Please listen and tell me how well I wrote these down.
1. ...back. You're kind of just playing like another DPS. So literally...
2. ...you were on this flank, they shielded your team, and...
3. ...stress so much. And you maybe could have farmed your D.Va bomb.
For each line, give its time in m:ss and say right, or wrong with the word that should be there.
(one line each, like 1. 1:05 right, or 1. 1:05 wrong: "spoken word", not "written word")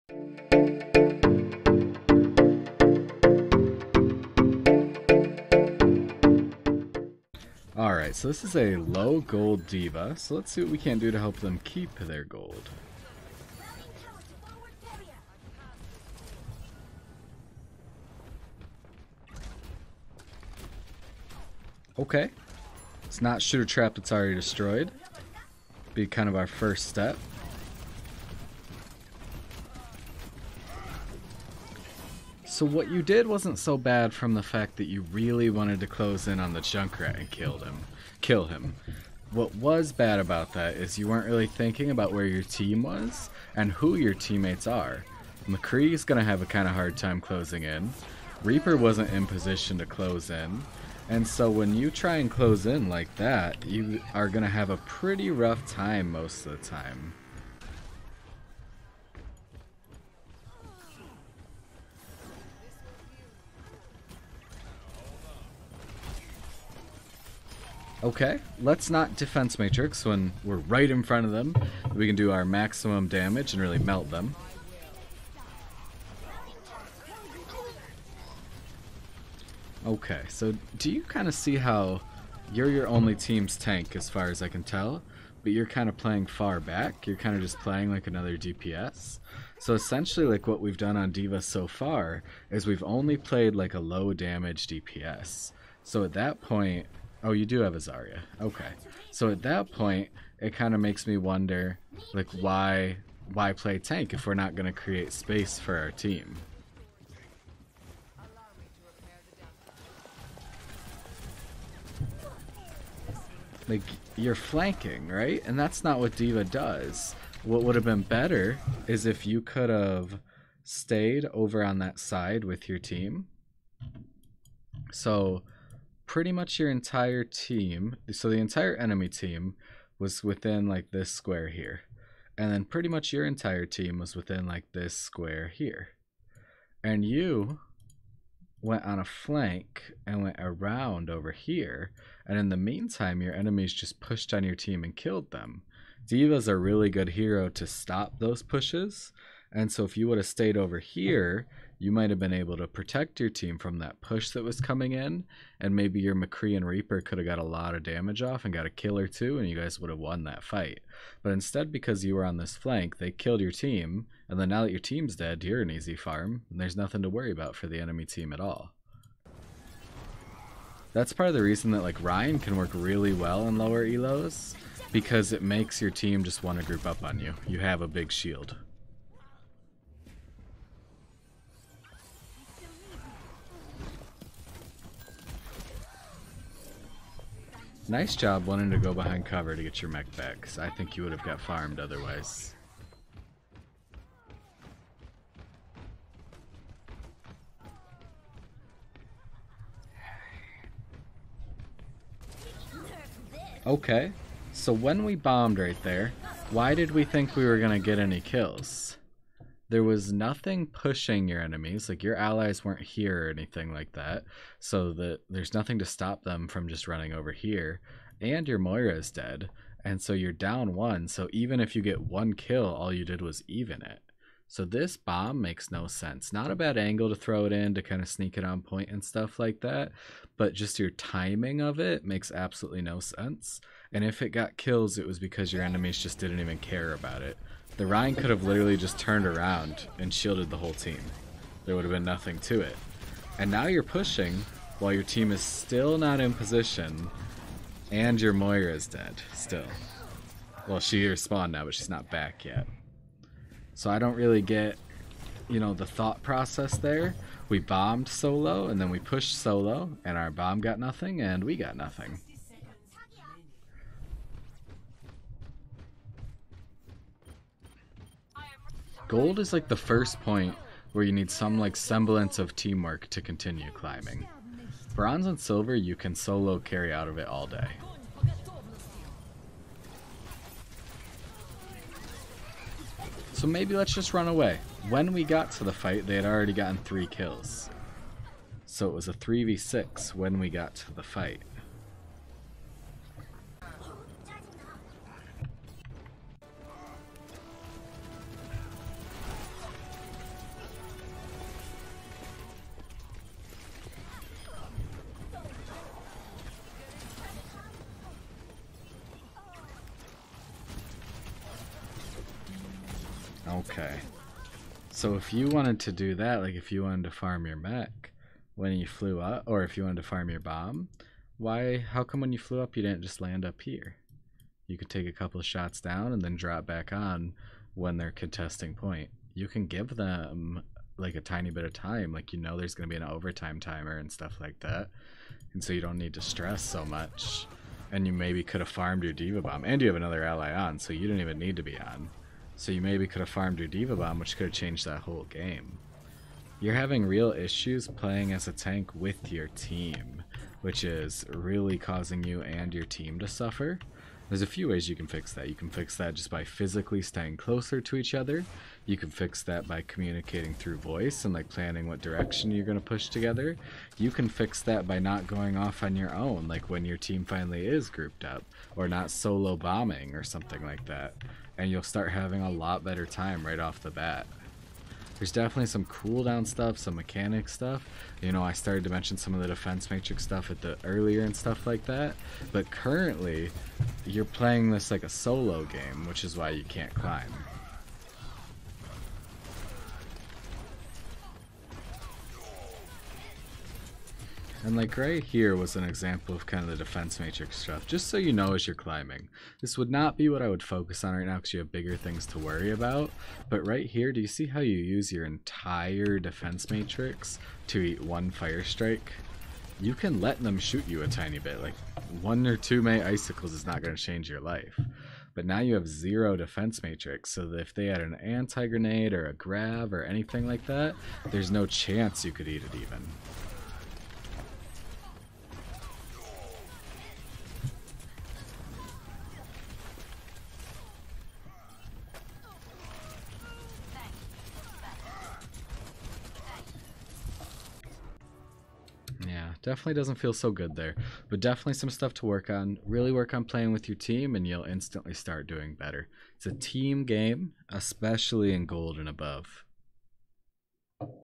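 1. 1:26 wrong: "essentially", not "literally"
2. 2:42 wrong: "killed", not "shielded"
3. 5:36 right.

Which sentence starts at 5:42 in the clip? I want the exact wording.
So you maybe could have farmed your D.Va Bomb, which could have changed that whole game.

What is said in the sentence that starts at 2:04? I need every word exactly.
So pretty much your entire team, so the entire enemy team was within like this square here.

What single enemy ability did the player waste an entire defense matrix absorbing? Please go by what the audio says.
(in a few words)
Fire strike.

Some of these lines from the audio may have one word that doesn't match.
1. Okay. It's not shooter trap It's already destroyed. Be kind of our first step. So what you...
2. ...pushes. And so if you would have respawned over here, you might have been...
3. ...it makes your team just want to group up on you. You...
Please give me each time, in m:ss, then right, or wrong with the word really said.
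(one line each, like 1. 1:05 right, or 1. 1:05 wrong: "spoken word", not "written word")
1. 0:21 right
2. 2:28 wrong: "stayed", not "respawned"
3. 2:55 right.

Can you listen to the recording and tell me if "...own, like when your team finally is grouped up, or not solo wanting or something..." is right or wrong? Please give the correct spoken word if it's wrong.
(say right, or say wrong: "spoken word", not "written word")
wrong: "bombing", not "wanting".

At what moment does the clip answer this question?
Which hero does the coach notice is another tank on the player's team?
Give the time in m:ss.
1:37.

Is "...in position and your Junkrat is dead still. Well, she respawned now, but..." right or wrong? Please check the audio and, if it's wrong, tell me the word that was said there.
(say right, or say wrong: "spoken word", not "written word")
wrong: "Moira", not "Junkrat".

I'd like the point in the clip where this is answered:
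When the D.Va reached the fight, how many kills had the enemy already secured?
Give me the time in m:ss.
4:46.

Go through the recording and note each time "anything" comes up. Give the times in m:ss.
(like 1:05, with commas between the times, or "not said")
3:33, 7:00.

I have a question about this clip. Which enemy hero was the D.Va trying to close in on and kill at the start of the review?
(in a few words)
Junkrat.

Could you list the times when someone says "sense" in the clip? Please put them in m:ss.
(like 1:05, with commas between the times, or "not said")
3:45, 3:52.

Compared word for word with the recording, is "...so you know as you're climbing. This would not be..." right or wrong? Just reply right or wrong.
right.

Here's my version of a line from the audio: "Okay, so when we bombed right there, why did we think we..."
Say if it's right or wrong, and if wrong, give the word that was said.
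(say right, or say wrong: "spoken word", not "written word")
right.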